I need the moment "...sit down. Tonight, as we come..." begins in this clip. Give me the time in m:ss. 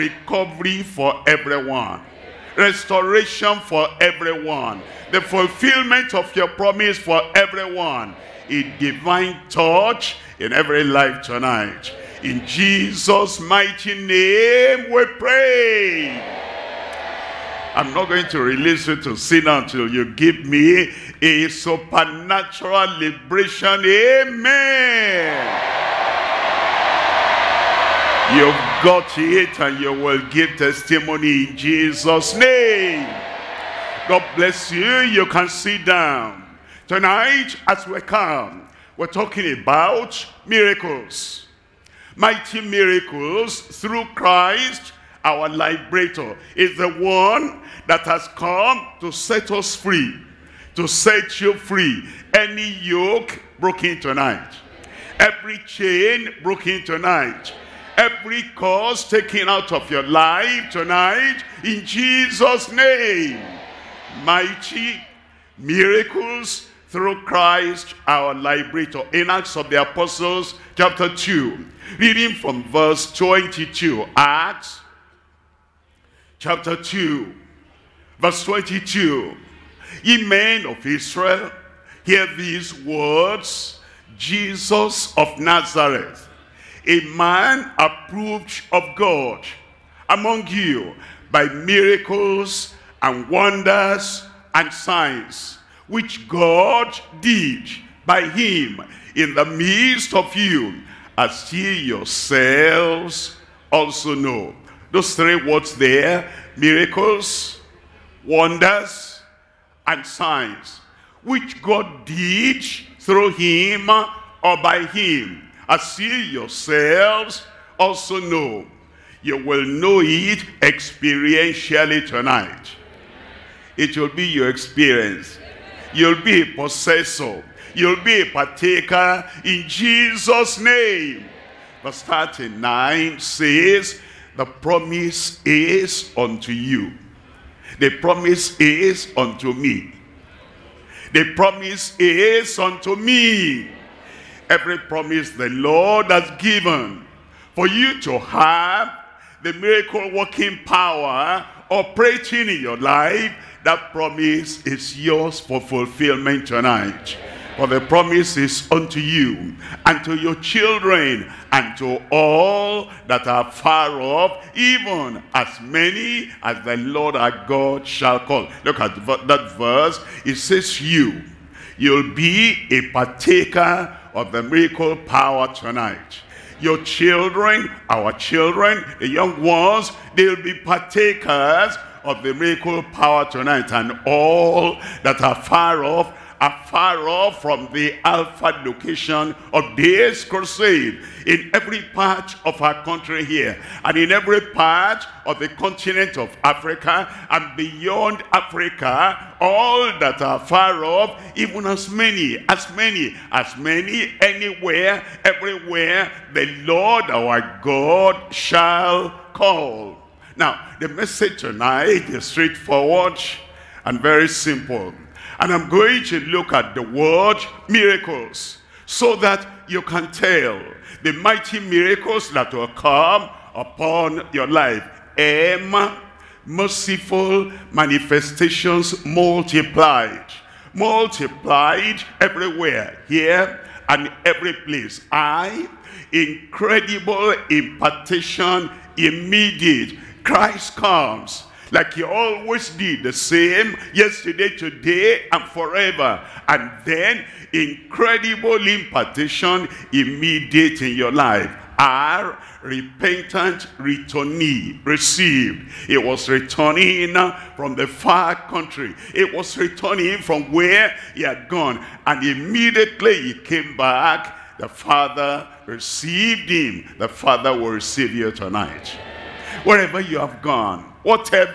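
0:35.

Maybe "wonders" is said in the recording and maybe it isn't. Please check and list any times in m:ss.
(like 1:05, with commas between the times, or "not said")
1:33, 1:48.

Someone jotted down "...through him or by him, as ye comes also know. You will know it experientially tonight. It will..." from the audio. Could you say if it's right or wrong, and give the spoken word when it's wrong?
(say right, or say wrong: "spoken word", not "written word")
wrong: "yourselves", not "comes".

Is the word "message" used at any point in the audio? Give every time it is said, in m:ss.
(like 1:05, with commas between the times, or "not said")
3:30.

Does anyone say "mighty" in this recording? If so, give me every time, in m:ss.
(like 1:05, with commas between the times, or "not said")
0:13, 0:42, 1:04, 3:41.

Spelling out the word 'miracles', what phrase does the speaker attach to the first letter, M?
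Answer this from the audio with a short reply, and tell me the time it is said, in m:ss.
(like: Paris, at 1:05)
Merciful manifestations multiplied, at 3:46.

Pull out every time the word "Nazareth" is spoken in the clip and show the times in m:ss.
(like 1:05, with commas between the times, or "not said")
1:25.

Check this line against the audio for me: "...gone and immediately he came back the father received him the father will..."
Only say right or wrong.
right.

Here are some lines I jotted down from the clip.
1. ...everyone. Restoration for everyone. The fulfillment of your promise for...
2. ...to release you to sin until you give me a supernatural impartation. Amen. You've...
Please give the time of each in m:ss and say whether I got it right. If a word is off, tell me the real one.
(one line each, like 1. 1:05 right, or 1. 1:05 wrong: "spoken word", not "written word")
1. 0:01 right
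2. 0:18 wrong: "liberation", not "impartation".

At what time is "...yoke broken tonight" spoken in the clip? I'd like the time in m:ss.
0:52.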